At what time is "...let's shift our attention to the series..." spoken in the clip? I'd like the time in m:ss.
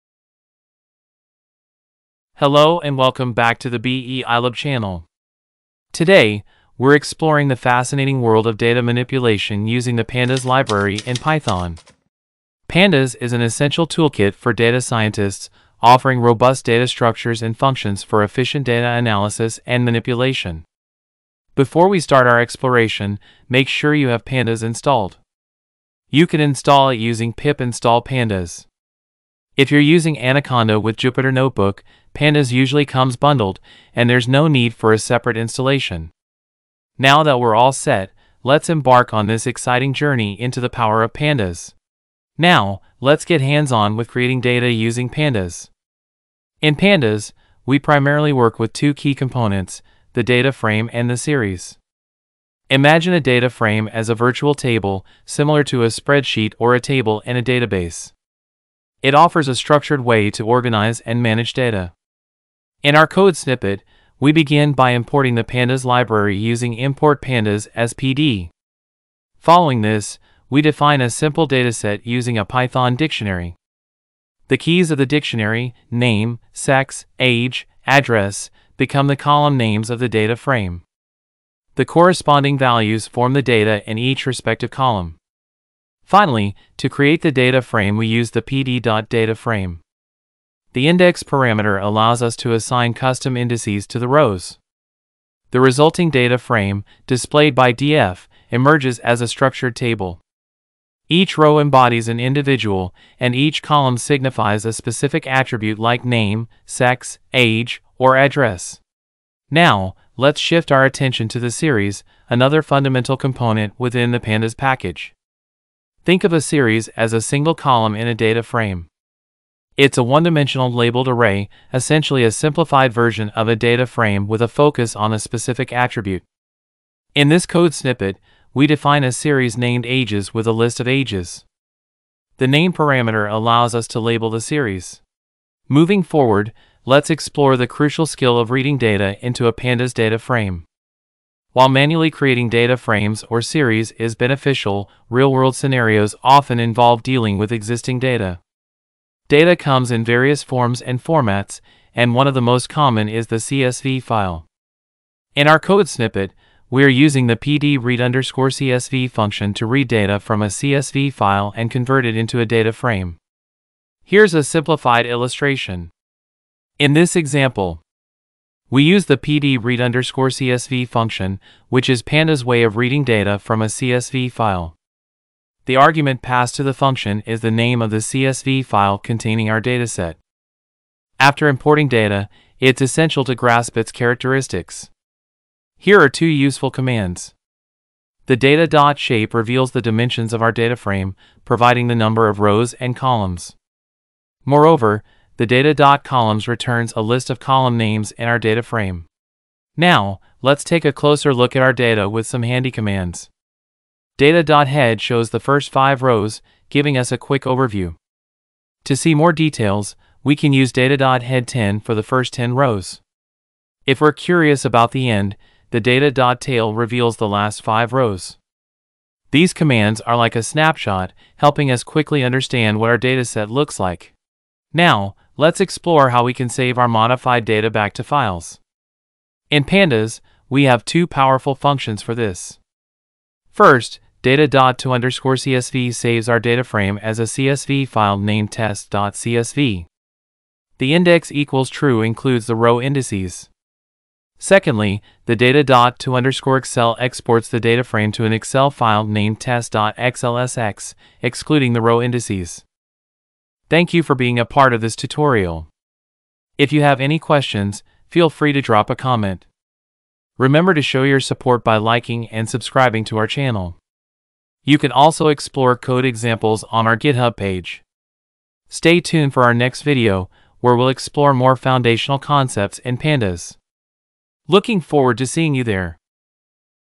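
1:50.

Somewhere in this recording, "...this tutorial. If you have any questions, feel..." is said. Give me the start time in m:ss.
4:14.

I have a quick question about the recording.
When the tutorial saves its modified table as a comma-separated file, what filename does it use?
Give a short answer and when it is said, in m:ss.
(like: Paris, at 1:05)
test.csv, at 3:58.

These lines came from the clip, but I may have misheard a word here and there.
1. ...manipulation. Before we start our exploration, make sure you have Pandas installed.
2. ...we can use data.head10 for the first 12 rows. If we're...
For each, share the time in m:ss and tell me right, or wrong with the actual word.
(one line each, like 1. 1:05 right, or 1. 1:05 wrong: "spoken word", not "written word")
1. 0:19 right
2. 3:30 wrong: "10", not "12".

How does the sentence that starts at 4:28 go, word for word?
Stay tuned for our next video, where we'll explore more foundational concepts in pandas.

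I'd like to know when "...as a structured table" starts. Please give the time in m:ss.
1:38.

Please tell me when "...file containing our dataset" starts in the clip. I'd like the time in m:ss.
2:58.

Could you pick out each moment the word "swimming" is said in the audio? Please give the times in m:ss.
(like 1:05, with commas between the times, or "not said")
not said.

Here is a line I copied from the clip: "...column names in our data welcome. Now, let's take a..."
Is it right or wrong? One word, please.
wrong.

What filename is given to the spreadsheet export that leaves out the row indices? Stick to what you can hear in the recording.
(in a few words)
test.xlsx.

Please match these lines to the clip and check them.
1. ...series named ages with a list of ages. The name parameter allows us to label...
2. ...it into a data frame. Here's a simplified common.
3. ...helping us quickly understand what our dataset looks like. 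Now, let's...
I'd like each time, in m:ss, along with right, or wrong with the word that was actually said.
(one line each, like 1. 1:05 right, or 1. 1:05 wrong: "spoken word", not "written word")
1. 2:09 right
2. 2:42 wrong: "illustration", not "common"
3. 3:41 right.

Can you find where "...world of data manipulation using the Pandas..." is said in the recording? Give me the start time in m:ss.
0:08.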